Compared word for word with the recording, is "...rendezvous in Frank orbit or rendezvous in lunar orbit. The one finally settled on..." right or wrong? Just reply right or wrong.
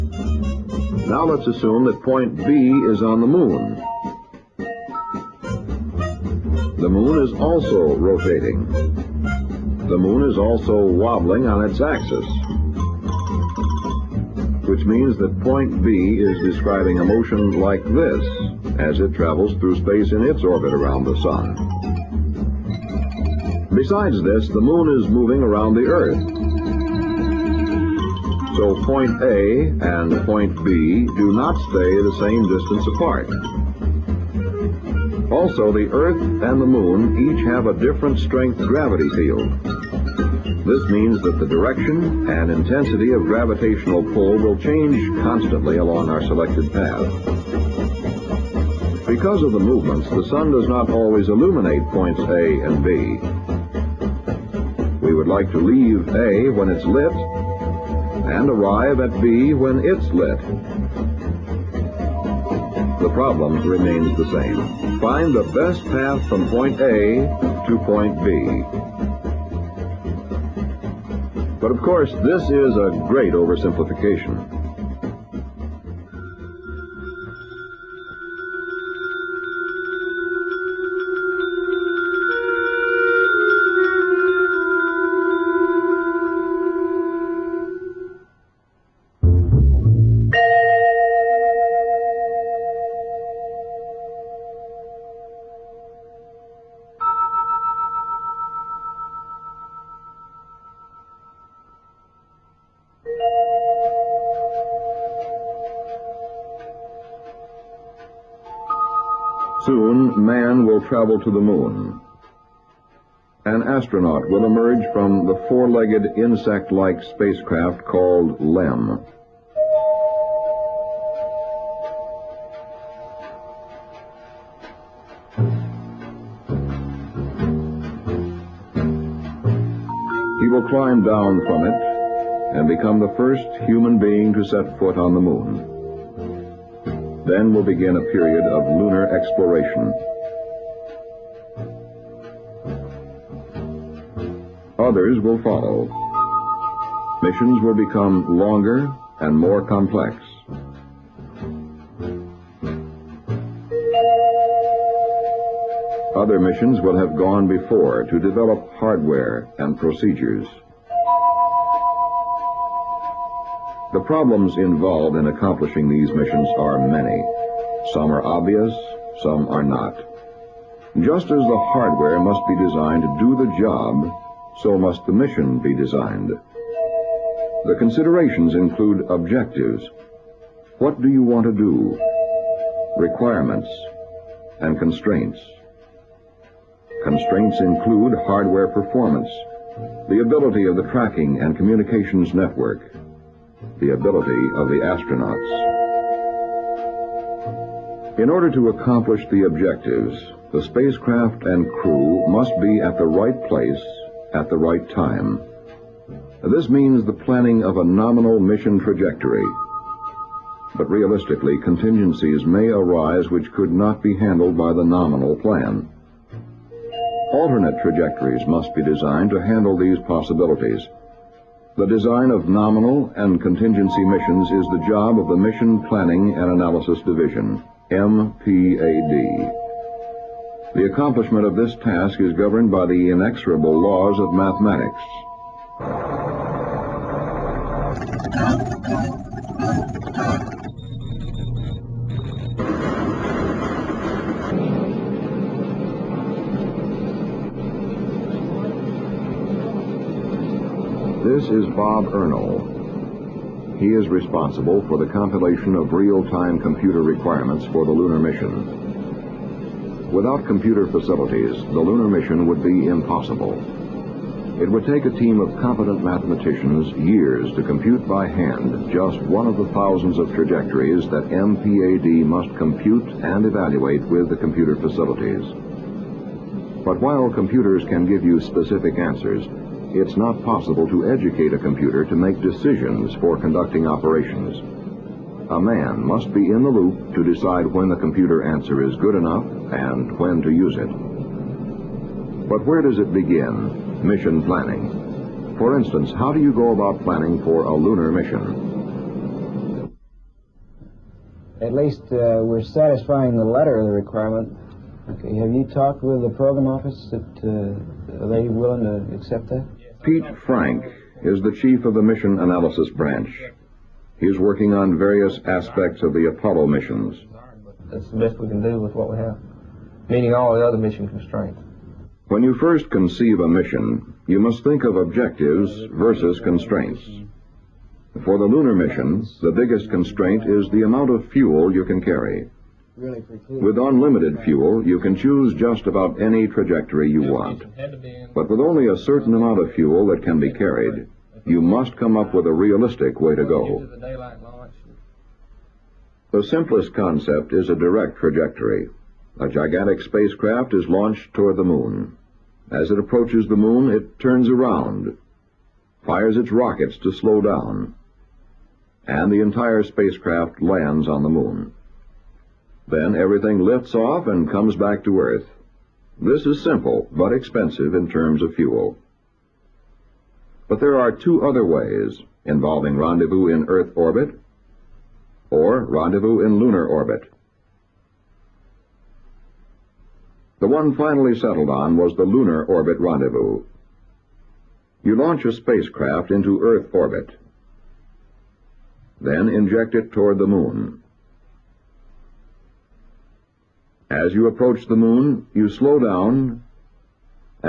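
wrong.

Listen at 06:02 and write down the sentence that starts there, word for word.
Then everything lifts off and comes back to Earth.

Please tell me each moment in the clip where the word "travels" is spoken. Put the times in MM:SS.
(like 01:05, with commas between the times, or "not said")
00:19, 01:50.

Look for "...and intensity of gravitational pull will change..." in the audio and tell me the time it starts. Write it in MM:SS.
00:42.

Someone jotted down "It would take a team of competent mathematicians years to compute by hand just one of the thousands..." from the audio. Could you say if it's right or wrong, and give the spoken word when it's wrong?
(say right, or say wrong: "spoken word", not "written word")
right.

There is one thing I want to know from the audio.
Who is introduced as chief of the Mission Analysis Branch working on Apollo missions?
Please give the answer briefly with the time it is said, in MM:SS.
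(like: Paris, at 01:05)
Pete Frank, at 05:10.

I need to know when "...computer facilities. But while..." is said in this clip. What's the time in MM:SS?
04:34.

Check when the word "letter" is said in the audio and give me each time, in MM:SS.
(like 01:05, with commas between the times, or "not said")
05:03.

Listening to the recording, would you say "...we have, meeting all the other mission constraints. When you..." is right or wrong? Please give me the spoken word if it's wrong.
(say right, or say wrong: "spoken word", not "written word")
right.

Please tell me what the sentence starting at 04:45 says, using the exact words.
A man must be in the loop to decide when the computer answer is good enough and when to use it.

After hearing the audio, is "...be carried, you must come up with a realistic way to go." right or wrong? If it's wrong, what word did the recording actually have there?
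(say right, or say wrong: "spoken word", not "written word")
right.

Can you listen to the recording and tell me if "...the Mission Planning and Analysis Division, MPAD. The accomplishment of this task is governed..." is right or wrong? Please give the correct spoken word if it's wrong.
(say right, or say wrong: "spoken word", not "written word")
right.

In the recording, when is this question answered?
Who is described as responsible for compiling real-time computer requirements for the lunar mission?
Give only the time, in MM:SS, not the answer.
04:11.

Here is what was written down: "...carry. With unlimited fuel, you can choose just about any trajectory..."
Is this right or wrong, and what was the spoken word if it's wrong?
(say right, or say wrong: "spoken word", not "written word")
right.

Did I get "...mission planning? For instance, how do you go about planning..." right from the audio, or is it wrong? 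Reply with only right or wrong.
right.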